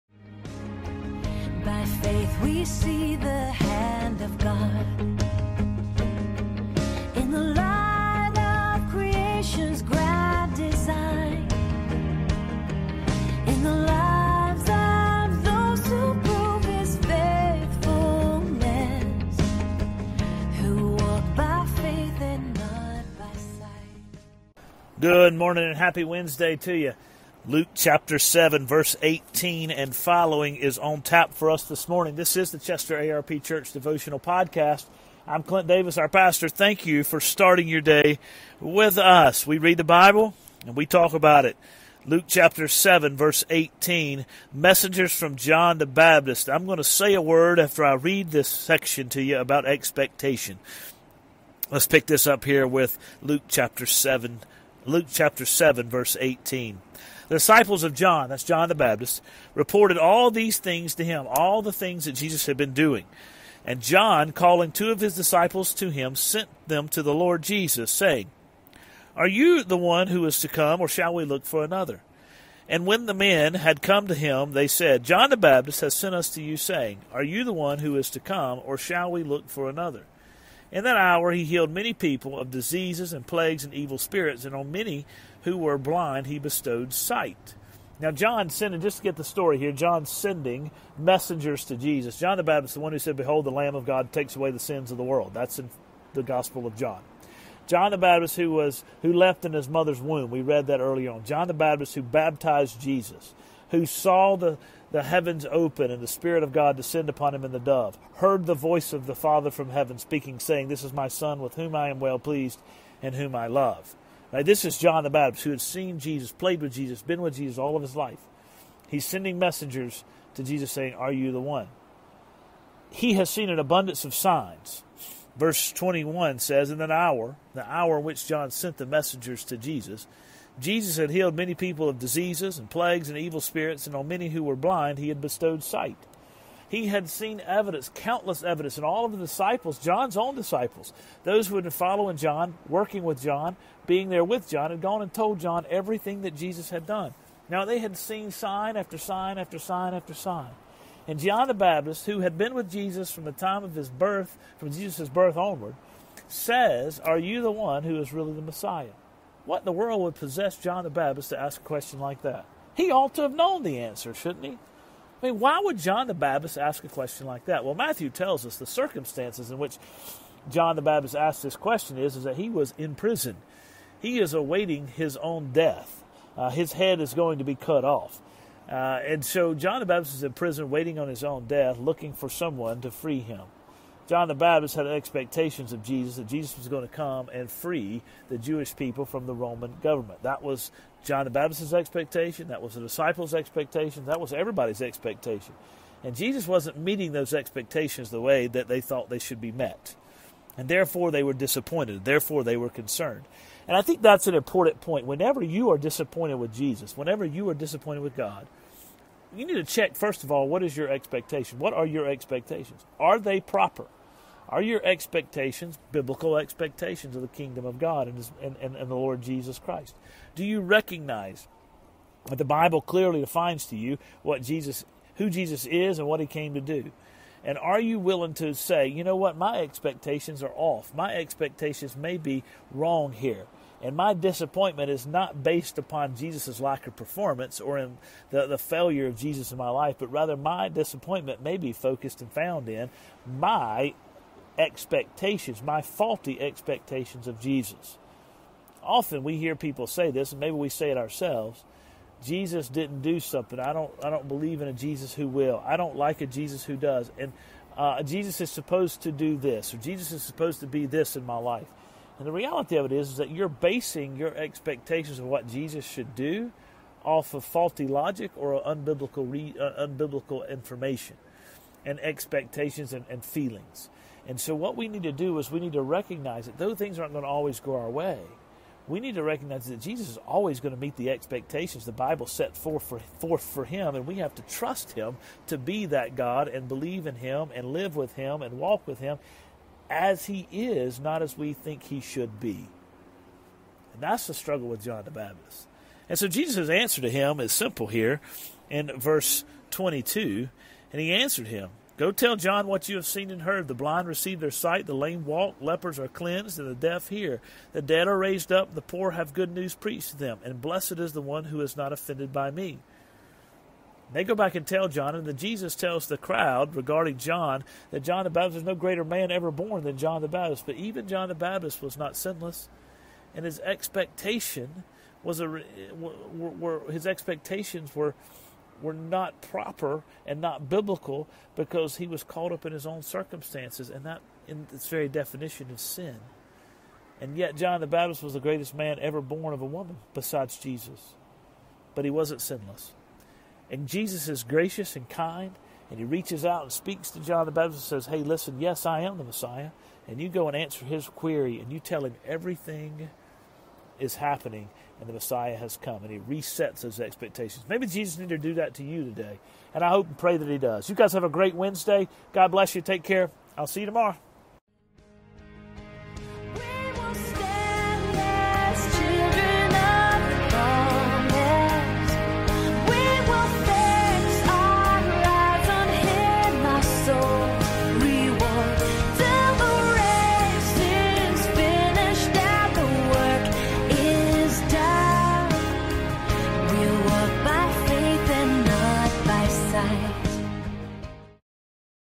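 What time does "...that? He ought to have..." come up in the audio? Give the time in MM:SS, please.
02:42.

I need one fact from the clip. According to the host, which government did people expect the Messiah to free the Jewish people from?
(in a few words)
Roman government.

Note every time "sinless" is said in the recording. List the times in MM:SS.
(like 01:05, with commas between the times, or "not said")
05:22, 05:42.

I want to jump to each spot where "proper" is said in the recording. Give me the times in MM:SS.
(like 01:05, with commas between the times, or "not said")
03:33, 05:29.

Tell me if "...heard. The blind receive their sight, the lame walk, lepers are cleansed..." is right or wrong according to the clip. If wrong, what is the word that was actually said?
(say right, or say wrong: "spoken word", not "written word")
right.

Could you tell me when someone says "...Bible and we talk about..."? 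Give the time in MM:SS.
00:39.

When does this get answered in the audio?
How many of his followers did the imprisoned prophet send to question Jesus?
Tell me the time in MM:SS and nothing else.
01:04.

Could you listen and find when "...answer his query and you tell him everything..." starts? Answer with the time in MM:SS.
05:50.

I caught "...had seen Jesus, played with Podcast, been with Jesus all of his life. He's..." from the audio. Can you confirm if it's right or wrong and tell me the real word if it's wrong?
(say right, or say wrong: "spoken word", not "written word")
wrong: "Jesus", not "Podcast".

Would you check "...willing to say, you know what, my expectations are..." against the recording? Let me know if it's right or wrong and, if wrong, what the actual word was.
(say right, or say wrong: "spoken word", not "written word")
right.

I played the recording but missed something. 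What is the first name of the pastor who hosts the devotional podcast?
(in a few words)
Clint.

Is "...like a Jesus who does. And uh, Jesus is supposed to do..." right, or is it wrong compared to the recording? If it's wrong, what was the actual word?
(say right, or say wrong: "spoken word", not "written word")
right.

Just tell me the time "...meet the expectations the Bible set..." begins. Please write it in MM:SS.
04:40.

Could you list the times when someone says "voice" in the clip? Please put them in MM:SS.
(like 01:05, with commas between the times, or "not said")
01:48.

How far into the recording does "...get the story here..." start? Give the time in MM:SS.
01:29.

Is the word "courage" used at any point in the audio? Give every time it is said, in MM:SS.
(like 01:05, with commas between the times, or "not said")
not said.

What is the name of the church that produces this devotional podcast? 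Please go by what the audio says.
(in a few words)
Chester ARP Church.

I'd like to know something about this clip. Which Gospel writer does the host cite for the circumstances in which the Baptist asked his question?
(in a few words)
Matthew.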